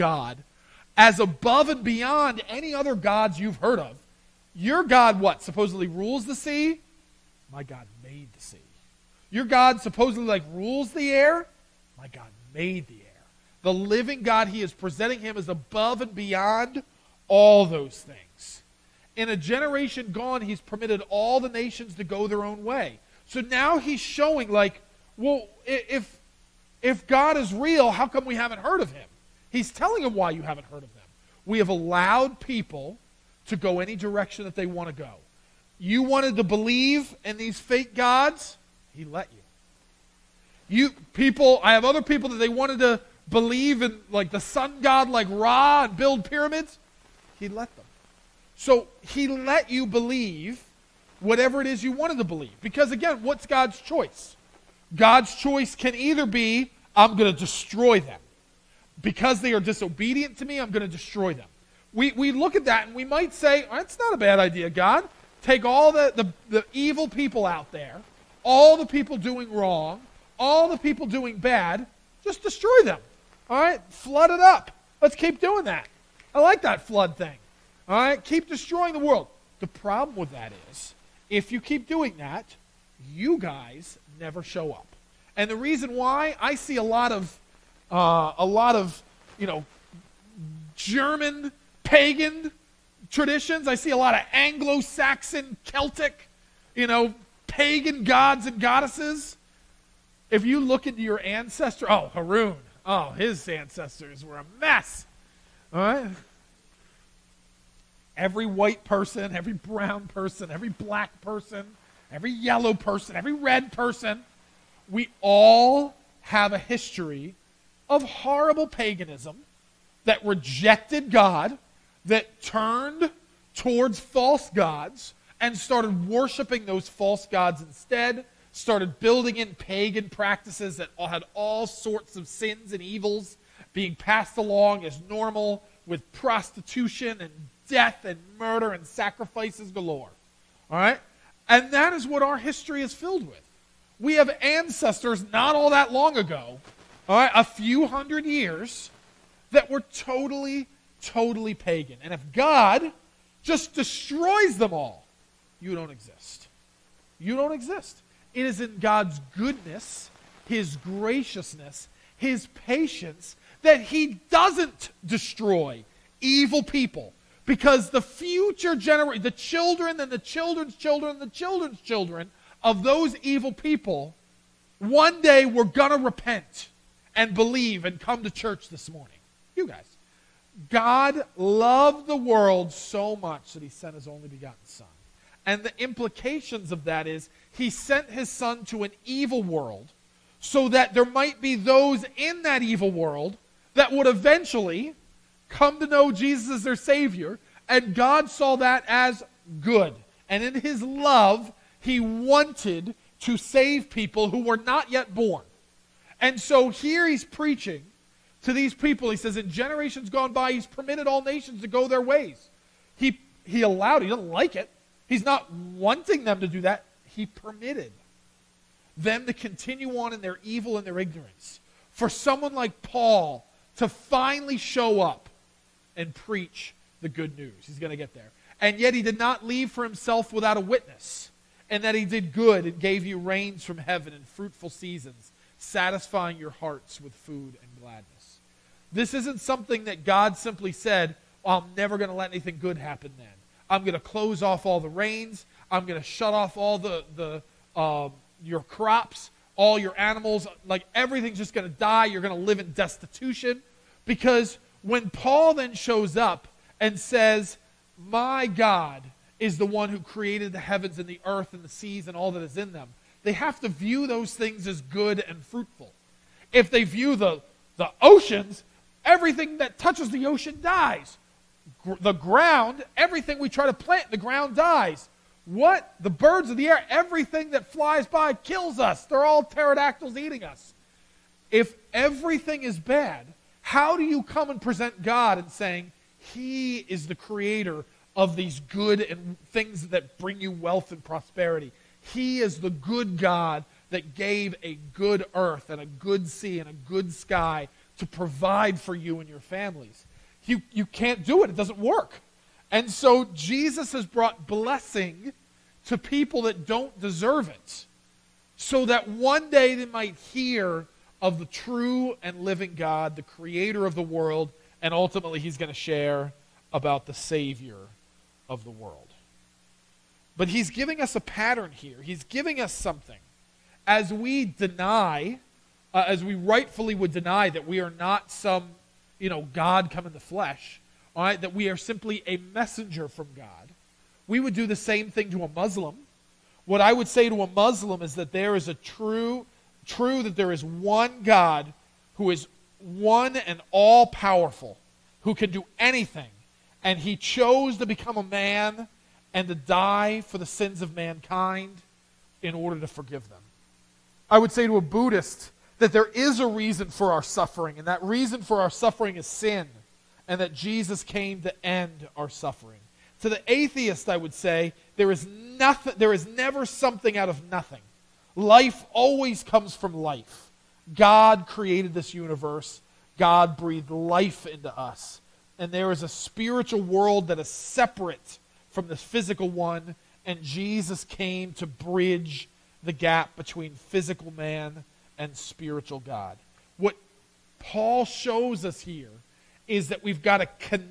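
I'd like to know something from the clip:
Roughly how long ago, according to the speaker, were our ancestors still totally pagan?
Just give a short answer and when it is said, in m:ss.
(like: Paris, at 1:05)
A few hundred years, at 2:27.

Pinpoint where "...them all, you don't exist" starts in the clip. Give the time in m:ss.
2:34.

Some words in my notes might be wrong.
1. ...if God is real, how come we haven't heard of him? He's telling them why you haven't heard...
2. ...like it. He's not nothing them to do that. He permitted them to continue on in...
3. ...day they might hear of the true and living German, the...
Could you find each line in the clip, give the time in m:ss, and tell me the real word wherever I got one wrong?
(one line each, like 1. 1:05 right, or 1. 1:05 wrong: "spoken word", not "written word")
1. 0:26 right
2. 3:34 wrong: "wanting", not "nothing"
3. 5:09 wrong: "God", not "German".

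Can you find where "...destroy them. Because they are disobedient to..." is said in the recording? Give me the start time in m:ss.
0:57.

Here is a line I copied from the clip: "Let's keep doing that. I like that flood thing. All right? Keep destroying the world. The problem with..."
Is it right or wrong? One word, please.
right.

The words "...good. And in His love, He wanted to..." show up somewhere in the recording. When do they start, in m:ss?
3:19.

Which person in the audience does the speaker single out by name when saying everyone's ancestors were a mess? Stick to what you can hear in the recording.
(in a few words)
Harun.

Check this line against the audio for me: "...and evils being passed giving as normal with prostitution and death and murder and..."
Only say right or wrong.
wrong.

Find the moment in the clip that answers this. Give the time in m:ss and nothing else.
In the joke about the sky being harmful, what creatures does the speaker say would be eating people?
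4:39.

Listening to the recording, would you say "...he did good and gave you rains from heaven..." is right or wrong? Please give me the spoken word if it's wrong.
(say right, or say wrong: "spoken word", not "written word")
right.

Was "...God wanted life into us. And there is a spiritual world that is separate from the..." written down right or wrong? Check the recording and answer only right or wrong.
wrong.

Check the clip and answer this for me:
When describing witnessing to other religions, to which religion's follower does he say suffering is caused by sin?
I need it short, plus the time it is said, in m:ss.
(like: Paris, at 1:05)
A Buddhist, at 5:54.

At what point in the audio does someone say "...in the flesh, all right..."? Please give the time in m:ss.
5:30.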